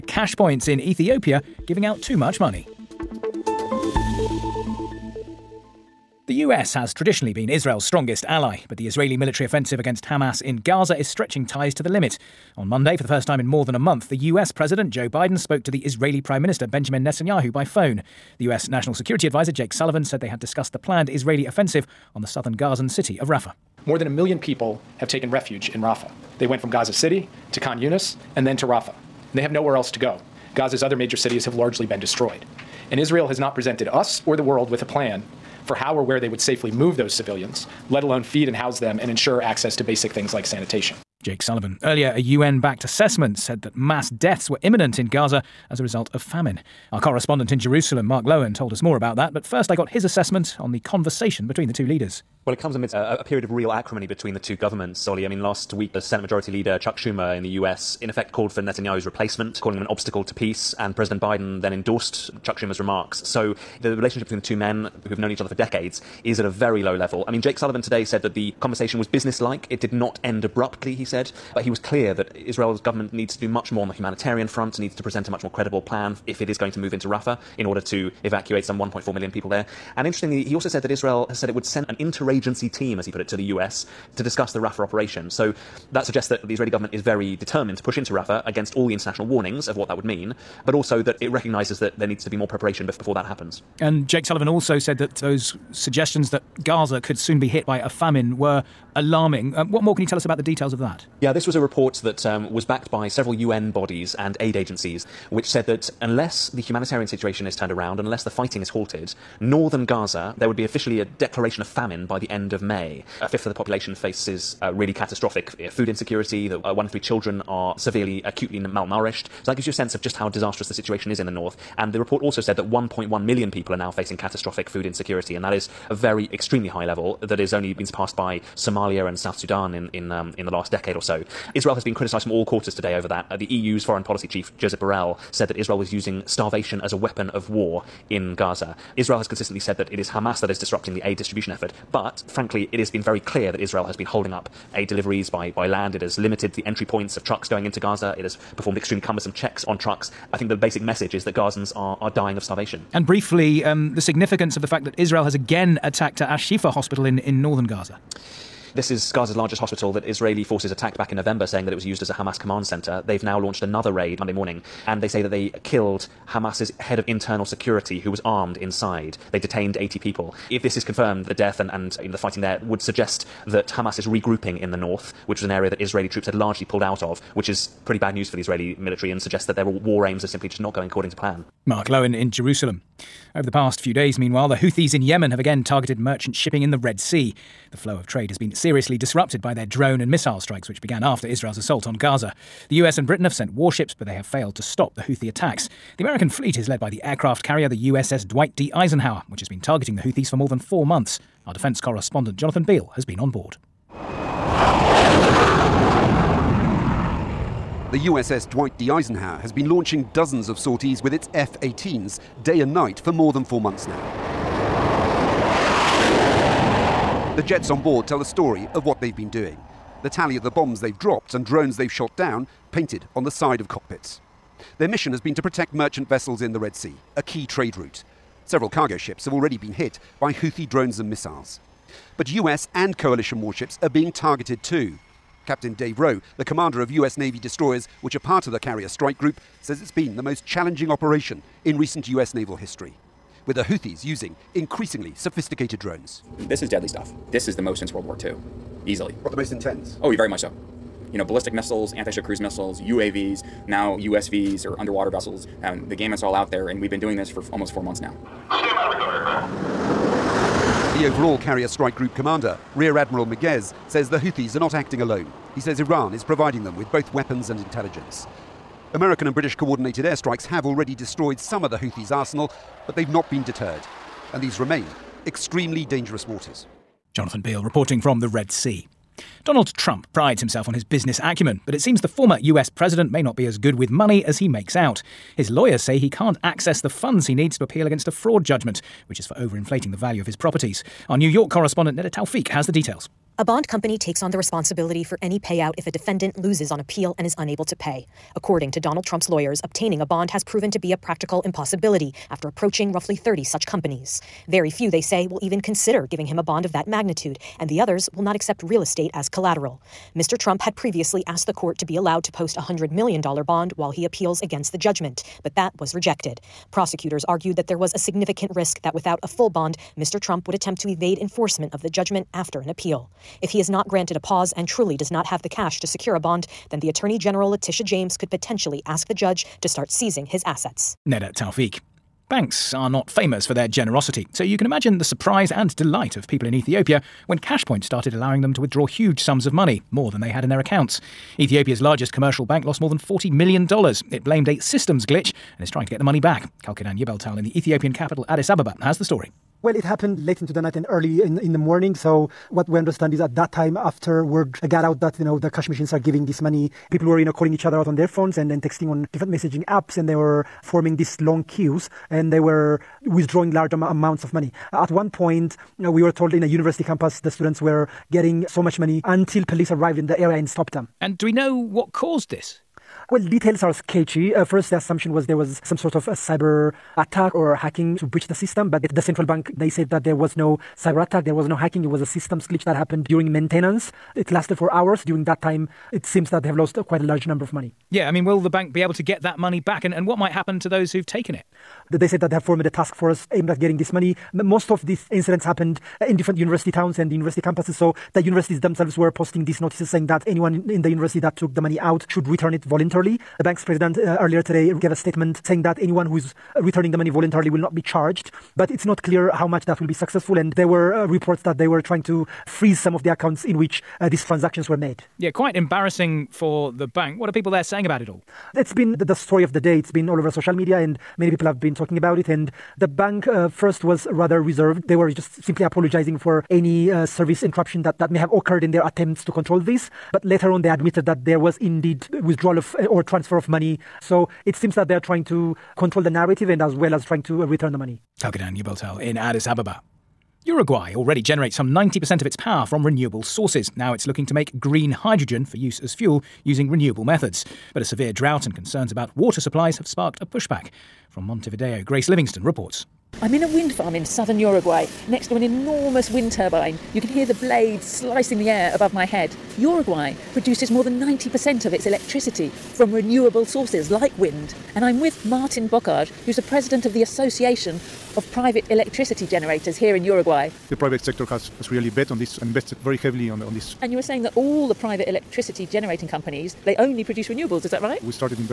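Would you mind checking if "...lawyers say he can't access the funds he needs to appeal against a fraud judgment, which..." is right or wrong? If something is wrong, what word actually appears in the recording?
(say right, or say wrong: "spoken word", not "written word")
right.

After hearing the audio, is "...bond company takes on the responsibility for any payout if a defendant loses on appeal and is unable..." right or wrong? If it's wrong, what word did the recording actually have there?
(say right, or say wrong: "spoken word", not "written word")
right.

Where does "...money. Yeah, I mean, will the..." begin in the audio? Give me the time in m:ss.
6:27.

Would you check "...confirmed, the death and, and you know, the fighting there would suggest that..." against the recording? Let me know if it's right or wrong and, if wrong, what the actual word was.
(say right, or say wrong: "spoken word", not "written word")
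right.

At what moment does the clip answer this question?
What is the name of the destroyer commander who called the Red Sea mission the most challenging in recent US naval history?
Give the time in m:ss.
3:55.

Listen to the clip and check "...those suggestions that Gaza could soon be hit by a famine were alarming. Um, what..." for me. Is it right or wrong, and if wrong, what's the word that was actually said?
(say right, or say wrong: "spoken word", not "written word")
right.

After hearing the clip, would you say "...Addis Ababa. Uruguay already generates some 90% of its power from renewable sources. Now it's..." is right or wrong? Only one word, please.
right.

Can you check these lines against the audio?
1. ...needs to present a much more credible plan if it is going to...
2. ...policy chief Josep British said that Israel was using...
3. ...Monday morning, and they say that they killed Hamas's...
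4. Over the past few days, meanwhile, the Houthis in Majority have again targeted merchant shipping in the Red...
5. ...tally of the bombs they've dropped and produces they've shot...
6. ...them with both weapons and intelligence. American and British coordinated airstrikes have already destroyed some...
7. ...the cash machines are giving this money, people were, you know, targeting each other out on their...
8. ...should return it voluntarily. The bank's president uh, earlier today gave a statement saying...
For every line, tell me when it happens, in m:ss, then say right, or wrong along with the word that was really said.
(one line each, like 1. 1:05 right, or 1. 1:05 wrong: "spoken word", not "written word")
1. 1:14 right
2. 2:14 wrong: "Borrell", not "British"
3. 2:44 right
4. 3:03 wrong: "Yemen", not "Majority"
5. 3:40 wrong: "drones", not "produces"
6. 4:26 right
7. 5:55 wrong: "calling", not "targeting"
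8. 6:42 right.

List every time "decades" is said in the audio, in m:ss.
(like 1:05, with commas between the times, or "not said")
1:05, 2:10.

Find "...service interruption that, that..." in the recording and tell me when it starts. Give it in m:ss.
7:07.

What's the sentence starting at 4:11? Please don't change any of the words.
You know, ballistic missiles, anti-ship cruise missiles, UAVs, now USVs or underwater vessels.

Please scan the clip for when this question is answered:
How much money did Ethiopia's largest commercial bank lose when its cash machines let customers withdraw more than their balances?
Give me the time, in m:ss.
5:42.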